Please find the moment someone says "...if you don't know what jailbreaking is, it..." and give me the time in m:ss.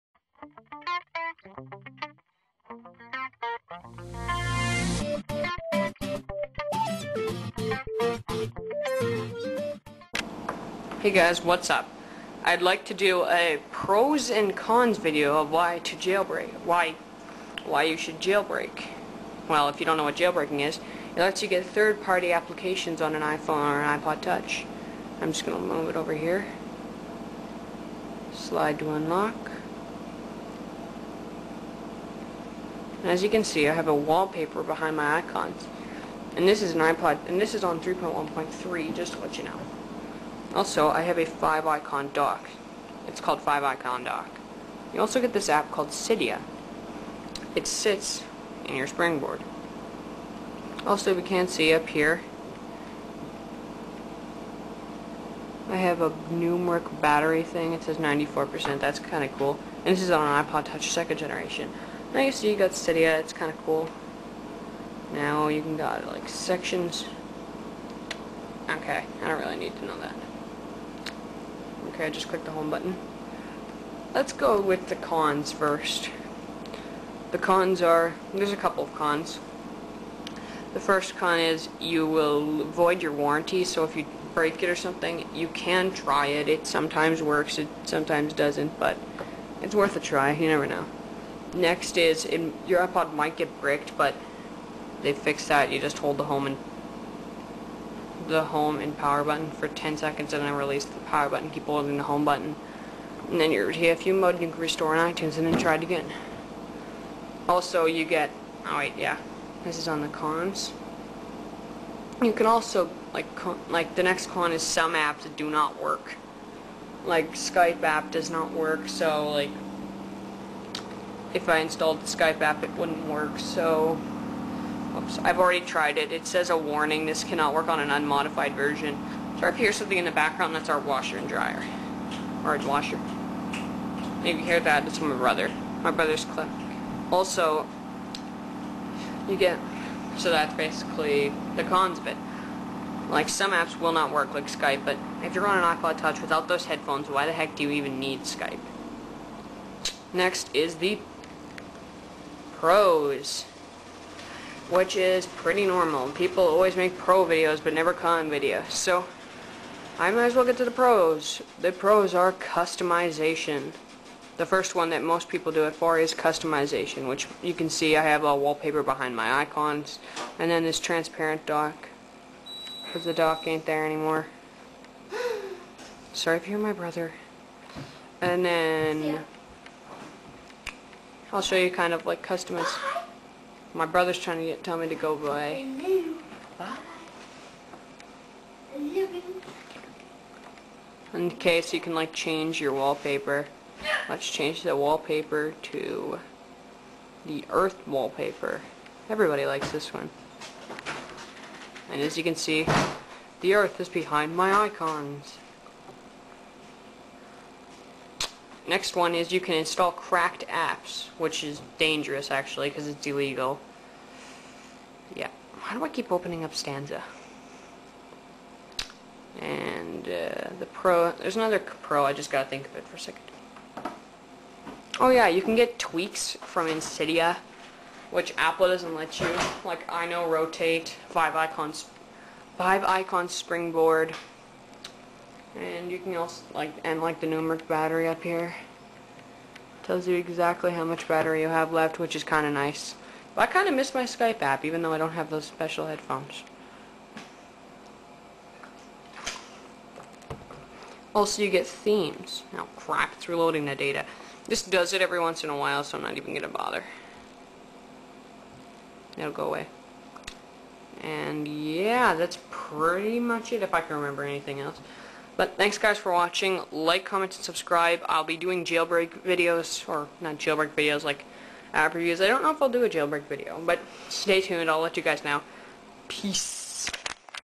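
0:19.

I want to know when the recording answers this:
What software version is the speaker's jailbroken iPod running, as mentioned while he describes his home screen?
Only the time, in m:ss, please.
0:37.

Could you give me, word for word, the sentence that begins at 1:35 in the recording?
You just hold the home and the home and power button for 10 seconds and then release the power button.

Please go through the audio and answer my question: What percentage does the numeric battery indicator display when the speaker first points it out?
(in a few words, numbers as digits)
94%.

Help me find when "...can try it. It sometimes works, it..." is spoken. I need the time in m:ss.
1:25.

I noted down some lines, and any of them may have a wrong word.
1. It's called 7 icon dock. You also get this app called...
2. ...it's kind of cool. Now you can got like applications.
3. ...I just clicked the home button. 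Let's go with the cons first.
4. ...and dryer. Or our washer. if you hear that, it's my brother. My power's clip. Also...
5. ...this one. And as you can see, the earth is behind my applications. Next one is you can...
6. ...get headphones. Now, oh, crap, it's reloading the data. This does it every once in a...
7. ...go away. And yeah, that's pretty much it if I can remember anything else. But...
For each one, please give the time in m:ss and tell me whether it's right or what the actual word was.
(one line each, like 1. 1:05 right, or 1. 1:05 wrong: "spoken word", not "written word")
1. 0:43 wrong: "5", not "7"
2. 1:03 wrong: "sections", not "applications"
3. 1:12 right
4. 2:11 wrong: "brother", not "power"
5. 3:19 wrong: "icons", not "applications"
6. 4:11 wrong: "themes", not "headphones"
7. 4:19 right.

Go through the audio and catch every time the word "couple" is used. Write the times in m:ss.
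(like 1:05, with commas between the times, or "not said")
1:18.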